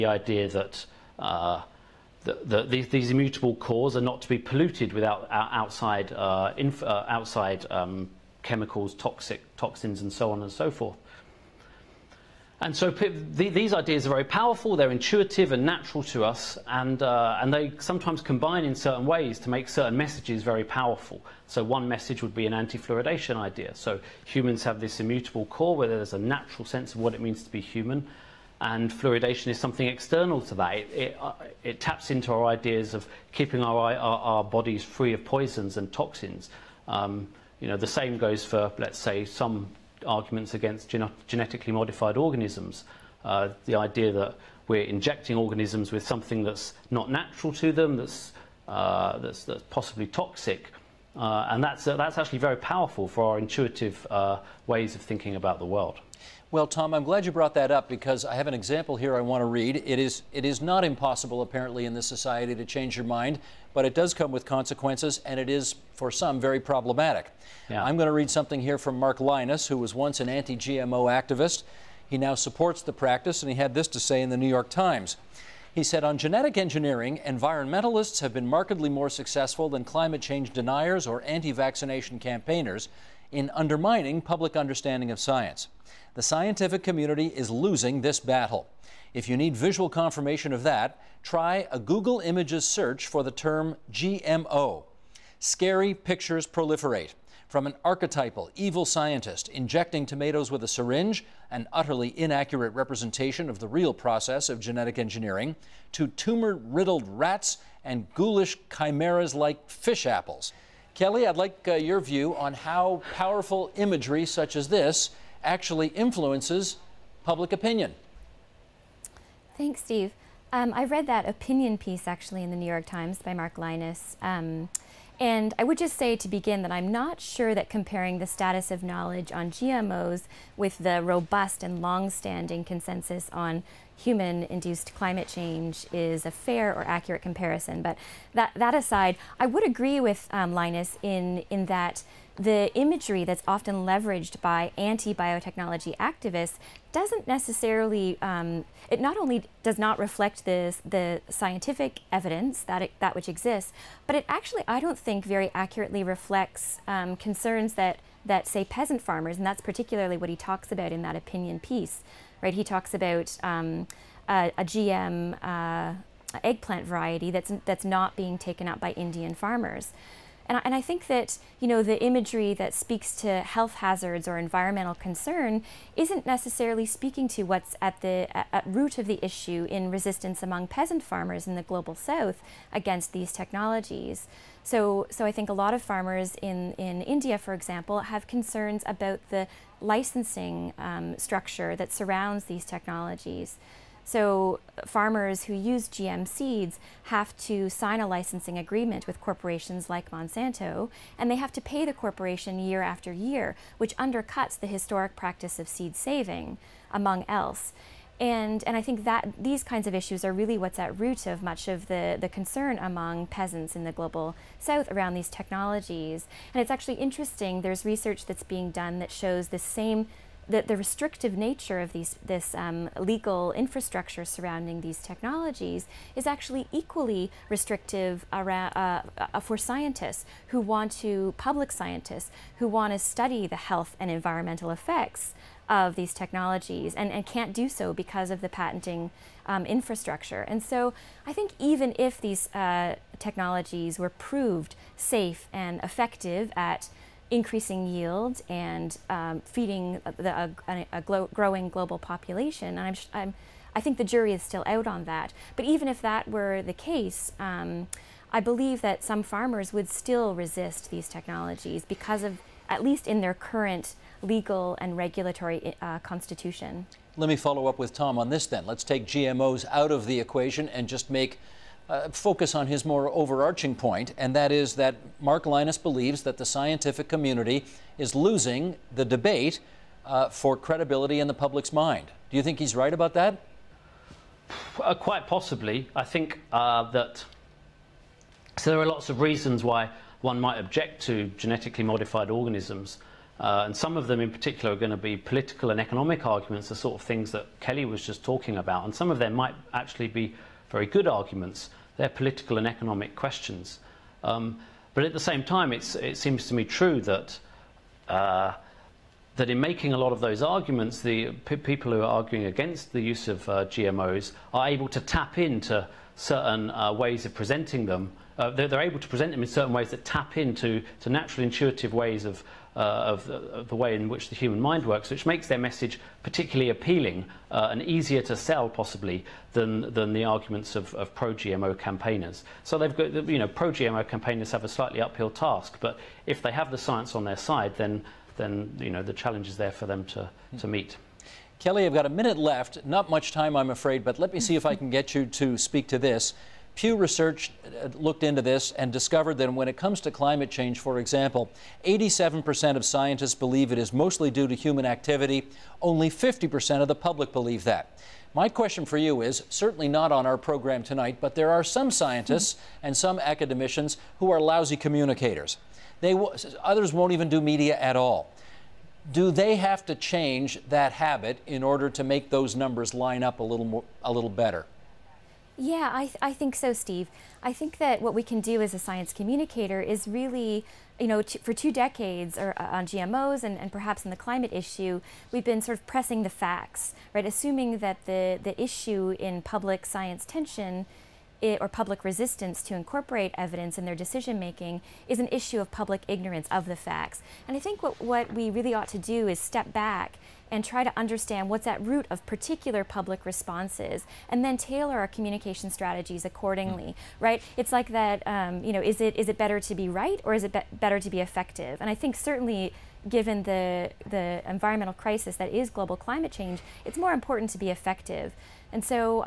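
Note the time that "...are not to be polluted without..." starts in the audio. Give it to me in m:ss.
0:03.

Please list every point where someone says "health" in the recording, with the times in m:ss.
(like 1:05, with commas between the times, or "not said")
2:53, 3:53.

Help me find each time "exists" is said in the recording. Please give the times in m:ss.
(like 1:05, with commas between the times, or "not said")
2:33.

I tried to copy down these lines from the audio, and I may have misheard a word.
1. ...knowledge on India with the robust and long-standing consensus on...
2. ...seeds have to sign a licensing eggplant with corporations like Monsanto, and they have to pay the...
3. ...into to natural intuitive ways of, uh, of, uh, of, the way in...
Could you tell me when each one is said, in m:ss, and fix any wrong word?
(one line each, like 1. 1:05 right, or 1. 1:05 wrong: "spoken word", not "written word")
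1. 2:08 wrong: "GMOs", not "India"
2. 3:16 wrong: "agreement", not "eggplant"
3. 5:20 right.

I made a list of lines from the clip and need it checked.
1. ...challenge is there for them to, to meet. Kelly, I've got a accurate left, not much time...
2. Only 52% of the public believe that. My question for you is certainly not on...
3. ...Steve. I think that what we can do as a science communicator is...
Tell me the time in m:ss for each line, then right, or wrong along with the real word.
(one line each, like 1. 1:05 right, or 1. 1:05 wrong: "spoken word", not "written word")
1. 5:39 wrong: "minute", not "accurate"
2. 5:55 wrong: "50", not "52"
3. 6:16 right.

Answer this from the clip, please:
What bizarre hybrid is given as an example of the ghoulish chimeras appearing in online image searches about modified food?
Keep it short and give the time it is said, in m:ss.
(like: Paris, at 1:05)
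fish apples, at 1:49.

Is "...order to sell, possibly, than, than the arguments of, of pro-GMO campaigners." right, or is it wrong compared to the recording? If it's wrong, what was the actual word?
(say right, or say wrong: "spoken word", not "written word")
wrong: "easier", not "order".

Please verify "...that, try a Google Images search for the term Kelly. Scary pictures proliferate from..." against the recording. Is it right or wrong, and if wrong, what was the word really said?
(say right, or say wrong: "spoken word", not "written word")
wrong: "GMO", not "Kelly".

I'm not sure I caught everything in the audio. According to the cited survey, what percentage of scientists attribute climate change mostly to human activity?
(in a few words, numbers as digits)
87%.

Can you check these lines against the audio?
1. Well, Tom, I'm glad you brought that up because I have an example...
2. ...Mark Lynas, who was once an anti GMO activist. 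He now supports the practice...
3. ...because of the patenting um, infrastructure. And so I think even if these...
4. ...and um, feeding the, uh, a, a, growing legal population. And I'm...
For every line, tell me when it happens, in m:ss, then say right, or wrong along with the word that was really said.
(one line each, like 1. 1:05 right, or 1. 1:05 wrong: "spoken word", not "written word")
1. 0:56 right
2. 1:08 right
3. 3:57 right
4. 4:08 wrong: "global", not "legal".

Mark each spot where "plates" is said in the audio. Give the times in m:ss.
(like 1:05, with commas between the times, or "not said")
not said.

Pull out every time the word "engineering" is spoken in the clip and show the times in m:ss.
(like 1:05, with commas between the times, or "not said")
1:16, 1:44.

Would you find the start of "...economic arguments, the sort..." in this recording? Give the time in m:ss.
4:55.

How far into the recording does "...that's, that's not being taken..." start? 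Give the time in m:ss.
2:47.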